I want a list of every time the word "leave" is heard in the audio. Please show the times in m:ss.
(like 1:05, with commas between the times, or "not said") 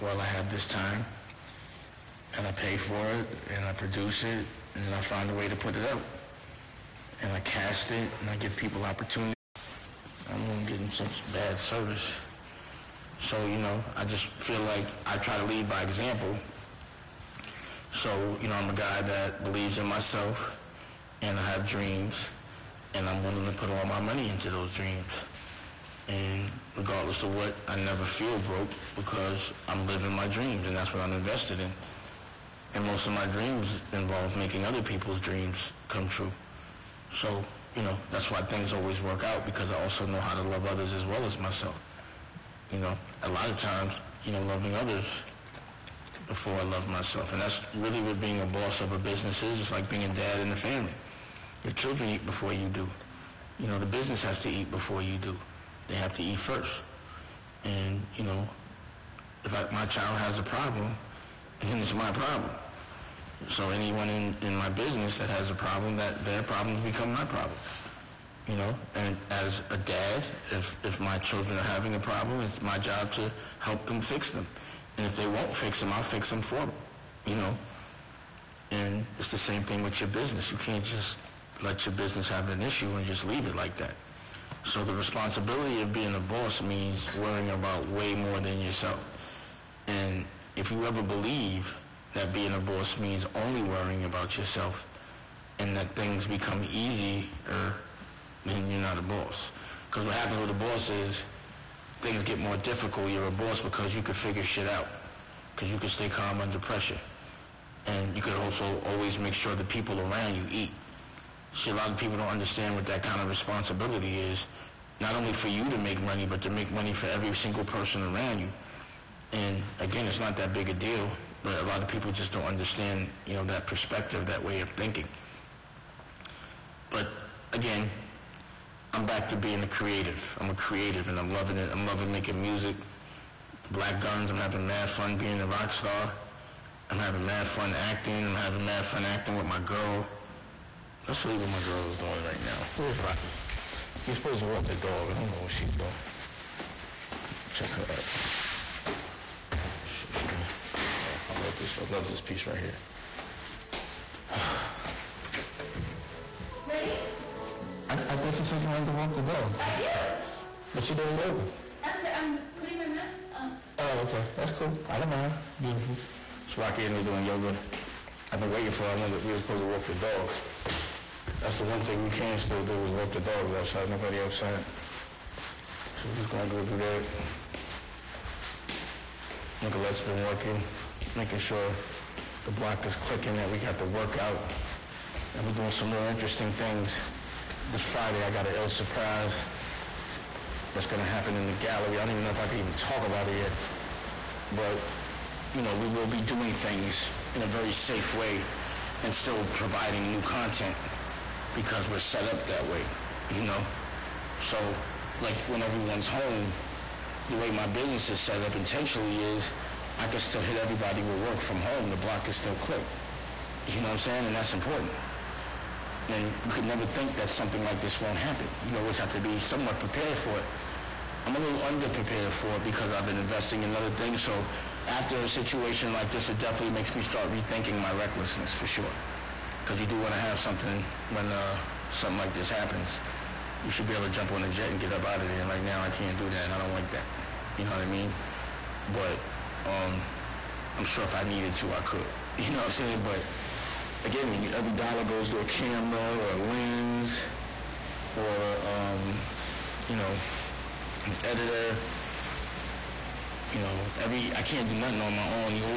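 1:23, 2:21.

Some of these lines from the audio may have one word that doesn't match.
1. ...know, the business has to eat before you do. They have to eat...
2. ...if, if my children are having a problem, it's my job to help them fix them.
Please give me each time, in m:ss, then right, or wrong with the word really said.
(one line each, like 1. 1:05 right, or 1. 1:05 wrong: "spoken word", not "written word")
1. 0:53 right
2. 1:10 right.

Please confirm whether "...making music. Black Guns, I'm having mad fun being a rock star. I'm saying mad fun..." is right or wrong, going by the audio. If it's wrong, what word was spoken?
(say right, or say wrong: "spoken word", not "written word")
wrong: "having", not "saying".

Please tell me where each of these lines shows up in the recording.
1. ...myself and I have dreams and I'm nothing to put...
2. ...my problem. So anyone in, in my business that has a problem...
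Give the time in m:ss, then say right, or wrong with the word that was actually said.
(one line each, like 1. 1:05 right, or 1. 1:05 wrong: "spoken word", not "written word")
1. 0:19 wrong: "willing", not "nothing"
2. 1:01 right.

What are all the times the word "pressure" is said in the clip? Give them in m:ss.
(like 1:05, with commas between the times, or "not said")
1:46.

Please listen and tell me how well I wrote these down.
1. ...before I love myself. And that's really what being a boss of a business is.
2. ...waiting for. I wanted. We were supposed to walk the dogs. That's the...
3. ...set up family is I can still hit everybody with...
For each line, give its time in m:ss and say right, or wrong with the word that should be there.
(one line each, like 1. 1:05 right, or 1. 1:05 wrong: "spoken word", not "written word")
1. 0:46 right
2. 2:48 right
3. 3:28 wrong: "intentionally", not "family".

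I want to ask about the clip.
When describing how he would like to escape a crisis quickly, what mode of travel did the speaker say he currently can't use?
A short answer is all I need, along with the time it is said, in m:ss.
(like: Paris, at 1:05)
Jet, at 3:54.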